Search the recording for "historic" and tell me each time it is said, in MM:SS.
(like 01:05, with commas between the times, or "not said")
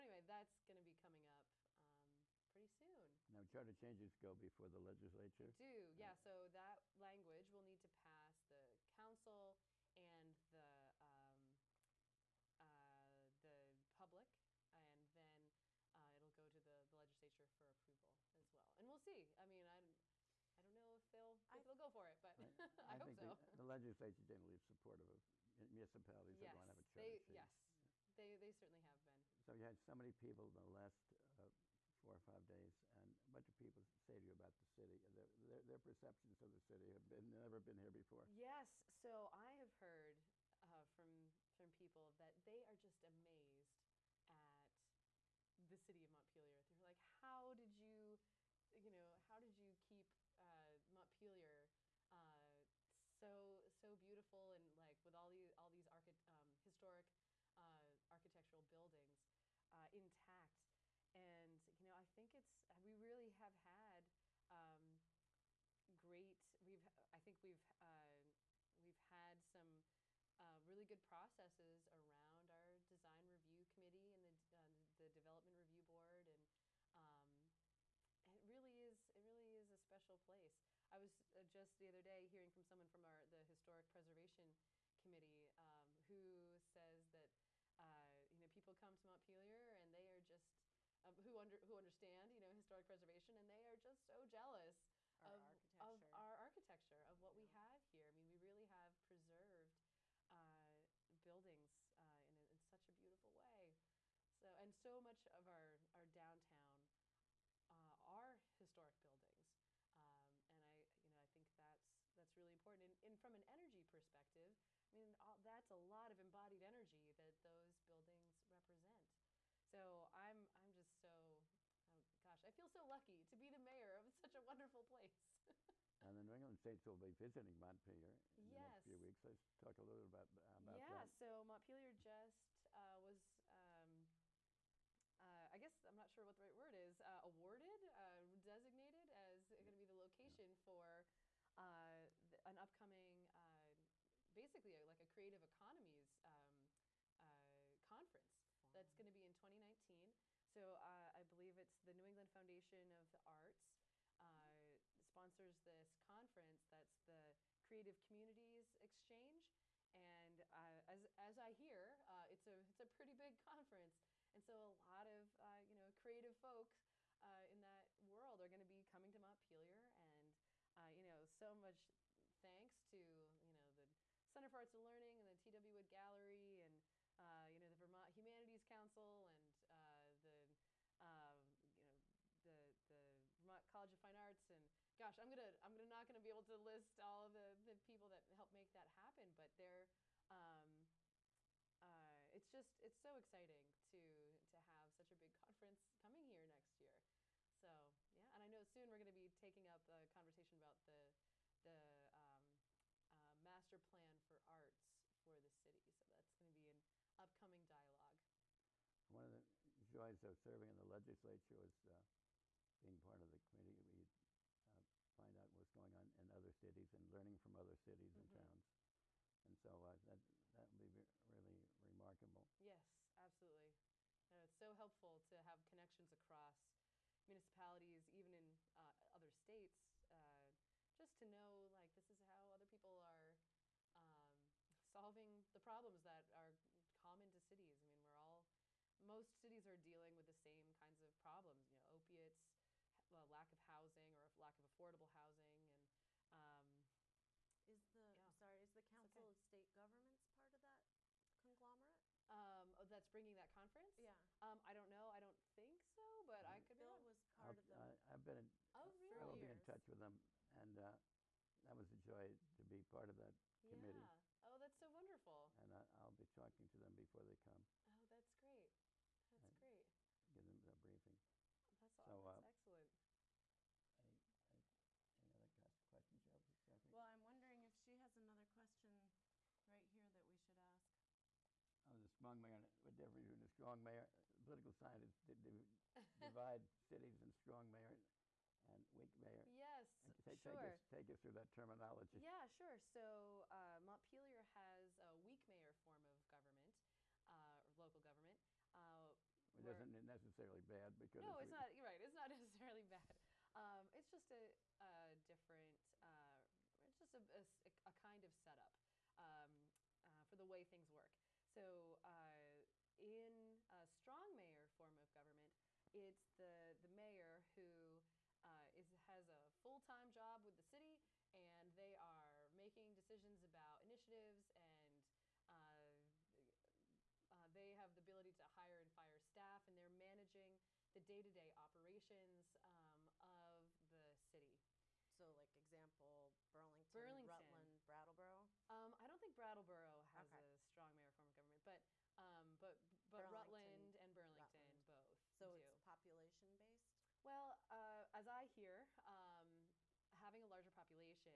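00:56, 01:23, 01:32, 01:48.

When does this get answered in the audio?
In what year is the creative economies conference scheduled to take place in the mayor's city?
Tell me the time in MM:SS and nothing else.
02:29.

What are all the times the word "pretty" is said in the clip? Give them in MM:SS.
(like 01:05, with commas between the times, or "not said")
00:02, 02:42.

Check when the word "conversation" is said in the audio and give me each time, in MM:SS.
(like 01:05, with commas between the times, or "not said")
03:20.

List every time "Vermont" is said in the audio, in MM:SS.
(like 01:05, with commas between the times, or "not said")
02:57, 03:03.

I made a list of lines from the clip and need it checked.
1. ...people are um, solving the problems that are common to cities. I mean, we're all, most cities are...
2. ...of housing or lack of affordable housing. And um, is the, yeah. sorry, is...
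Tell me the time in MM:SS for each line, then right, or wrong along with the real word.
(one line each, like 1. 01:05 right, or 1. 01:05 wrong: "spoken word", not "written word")
1. 03:52 right
2. 04:03 right.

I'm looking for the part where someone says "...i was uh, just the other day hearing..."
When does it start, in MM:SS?
01:20.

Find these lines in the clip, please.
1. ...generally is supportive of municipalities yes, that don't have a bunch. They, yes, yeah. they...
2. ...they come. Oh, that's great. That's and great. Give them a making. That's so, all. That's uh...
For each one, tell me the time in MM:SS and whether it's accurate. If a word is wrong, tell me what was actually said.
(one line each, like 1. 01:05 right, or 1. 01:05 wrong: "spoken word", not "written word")
1. 00:24 wrong: "church", not "bunch"
2. 04:27 wrong: "briefing", not "making".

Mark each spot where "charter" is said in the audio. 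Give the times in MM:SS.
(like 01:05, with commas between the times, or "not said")
00:03.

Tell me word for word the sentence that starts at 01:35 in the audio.
of our architecture of what yeah.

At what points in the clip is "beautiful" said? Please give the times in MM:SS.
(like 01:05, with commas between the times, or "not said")
00:53, 01:42.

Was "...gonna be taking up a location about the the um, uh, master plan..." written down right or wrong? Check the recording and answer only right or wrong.
wrong.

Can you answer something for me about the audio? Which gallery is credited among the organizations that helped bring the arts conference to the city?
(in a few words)
T.W. Wood Gallery.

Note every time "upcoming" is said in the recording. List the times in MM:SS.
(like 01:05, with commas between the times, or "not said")
02:22, 03:27.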